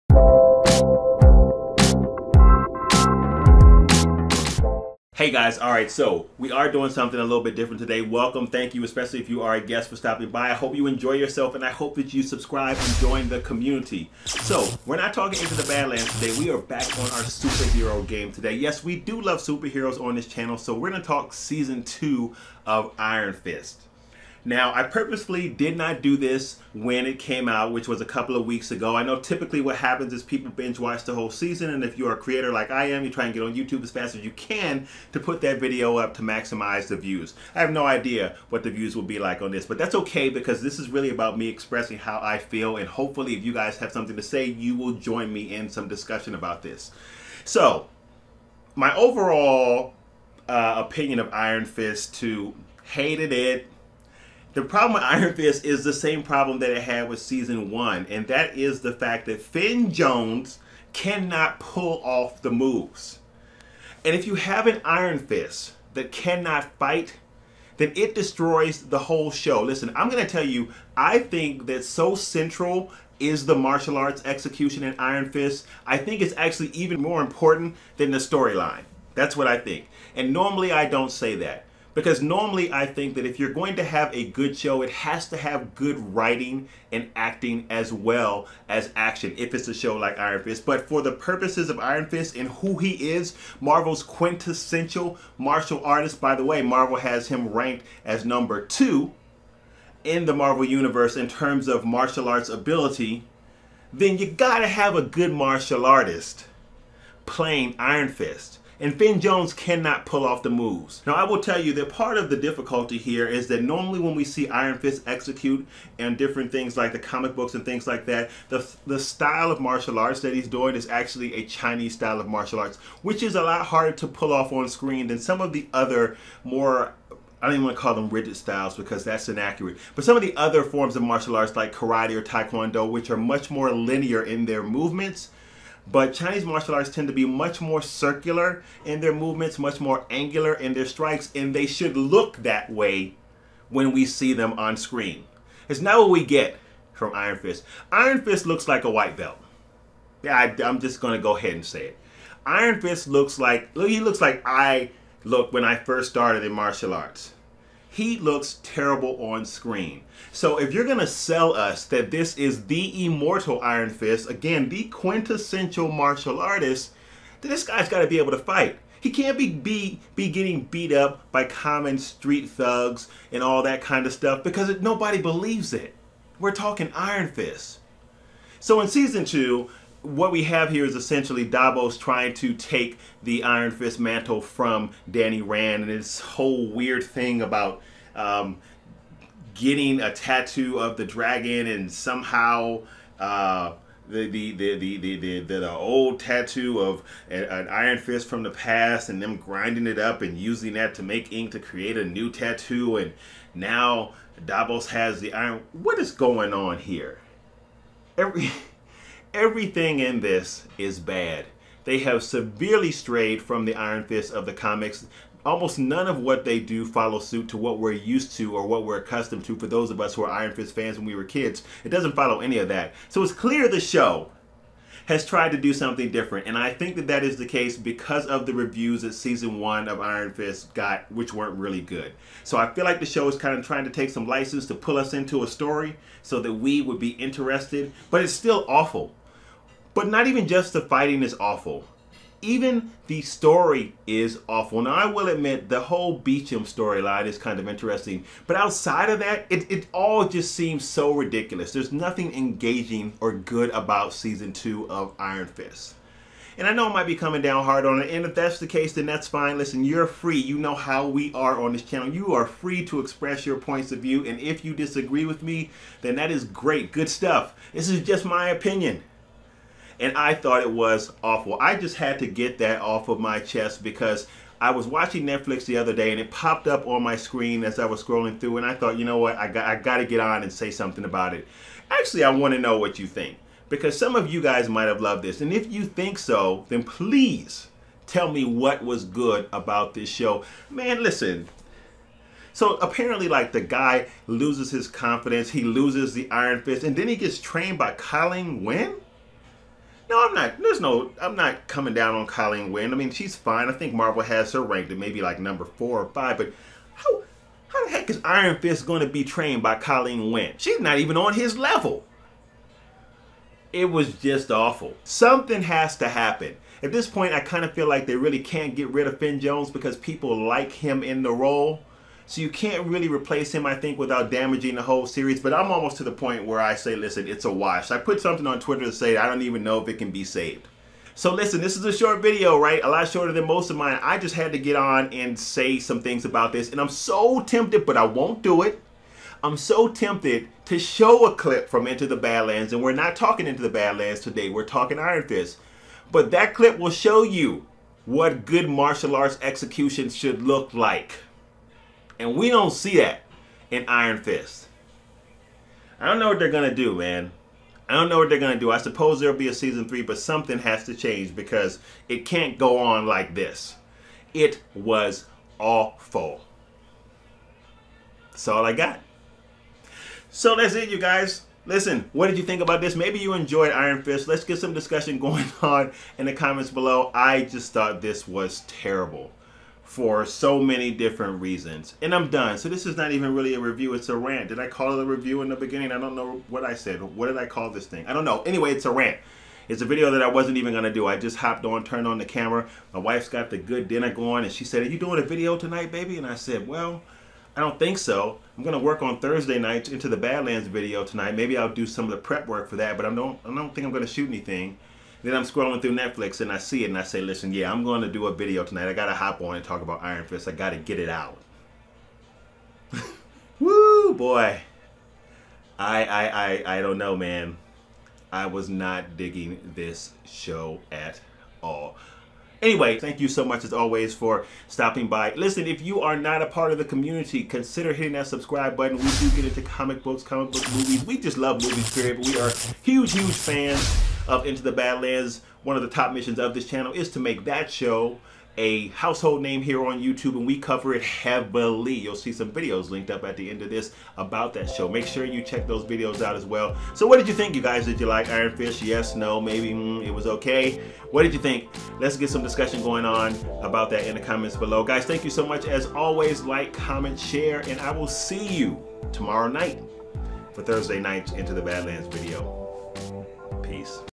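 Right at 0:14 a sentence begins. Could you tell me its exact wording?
So, we're not talking Into the Badlands today.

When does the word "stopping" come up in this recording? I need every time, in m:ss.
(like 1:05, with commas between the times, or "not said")
0:09, 7:04.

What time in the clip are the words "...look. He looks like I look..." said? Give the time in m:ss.
2:33.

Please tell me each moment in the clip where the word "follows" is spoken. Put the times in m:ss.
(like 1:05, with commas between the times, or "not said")
3:36, 3:42.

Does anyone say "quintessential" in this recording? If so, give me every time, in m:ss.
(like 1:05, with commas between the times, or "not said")
1:34, 2:44.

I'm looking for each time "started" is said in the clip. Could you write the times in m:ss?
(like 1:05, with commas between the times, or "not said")
2:36.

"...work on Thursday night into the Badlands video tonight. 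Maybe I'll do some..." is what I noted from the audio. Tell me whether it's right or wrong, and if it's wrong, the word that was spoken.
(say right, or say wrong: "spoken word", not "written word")
right.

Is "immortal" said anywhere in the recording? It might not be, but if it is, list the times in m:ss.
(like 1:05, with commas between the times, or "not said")
2:43.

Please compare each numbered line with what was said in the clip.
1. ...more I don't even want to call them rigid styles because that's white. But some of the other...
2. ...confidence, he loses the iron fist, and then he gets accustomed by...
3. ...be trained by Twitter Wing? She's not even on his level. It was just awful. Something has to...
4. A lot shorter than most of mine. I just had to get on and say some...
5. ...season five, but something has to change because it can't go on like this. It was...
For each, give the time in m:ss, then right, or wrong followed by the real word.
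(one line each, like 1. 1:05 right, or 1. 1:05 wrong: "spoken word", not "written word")
1. 2:06 wrong: "inaccurate", not "white"
2. 4:54 wrong: "trained", not "accustomed"
3. 5:09 wrong: "Colleen", not "Twitter"
4. 5:32 right
5. 5:59 wrong: "three", not "five".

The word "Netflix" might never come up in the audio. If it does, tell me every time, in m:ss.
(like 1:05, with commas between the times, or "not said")
4:35, 6:45.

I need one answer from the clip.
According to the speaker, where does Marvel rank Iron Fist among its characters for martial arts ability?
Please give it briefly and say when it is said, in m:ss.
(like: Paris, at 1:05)
2, at 1:38.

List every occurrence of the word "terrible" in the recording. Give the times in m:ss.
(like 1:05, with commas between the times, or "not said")
2:38, 6:18.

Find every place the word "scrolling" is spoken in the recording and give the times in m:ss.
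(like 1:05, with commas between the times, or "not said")
4:38, 6:45.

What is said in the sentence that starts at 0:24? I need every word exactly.
Now, I purposely did not do this when it came out, which was a couple of weeks ago.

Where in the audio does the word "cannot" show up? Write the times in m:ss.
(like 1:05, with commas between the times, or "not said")
1:00, 1:06, 1:49.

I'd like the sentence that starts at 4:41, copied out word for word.
Actually, I want to know what you think because some of you guys might have loved this.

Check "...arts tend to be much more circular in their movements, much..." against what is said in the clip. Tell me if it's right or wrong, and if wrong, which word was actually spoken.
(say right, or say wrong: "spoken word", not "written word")
right.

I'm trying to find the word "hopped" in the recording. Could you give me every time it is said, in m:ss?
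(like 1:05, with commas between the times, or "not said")
6:31.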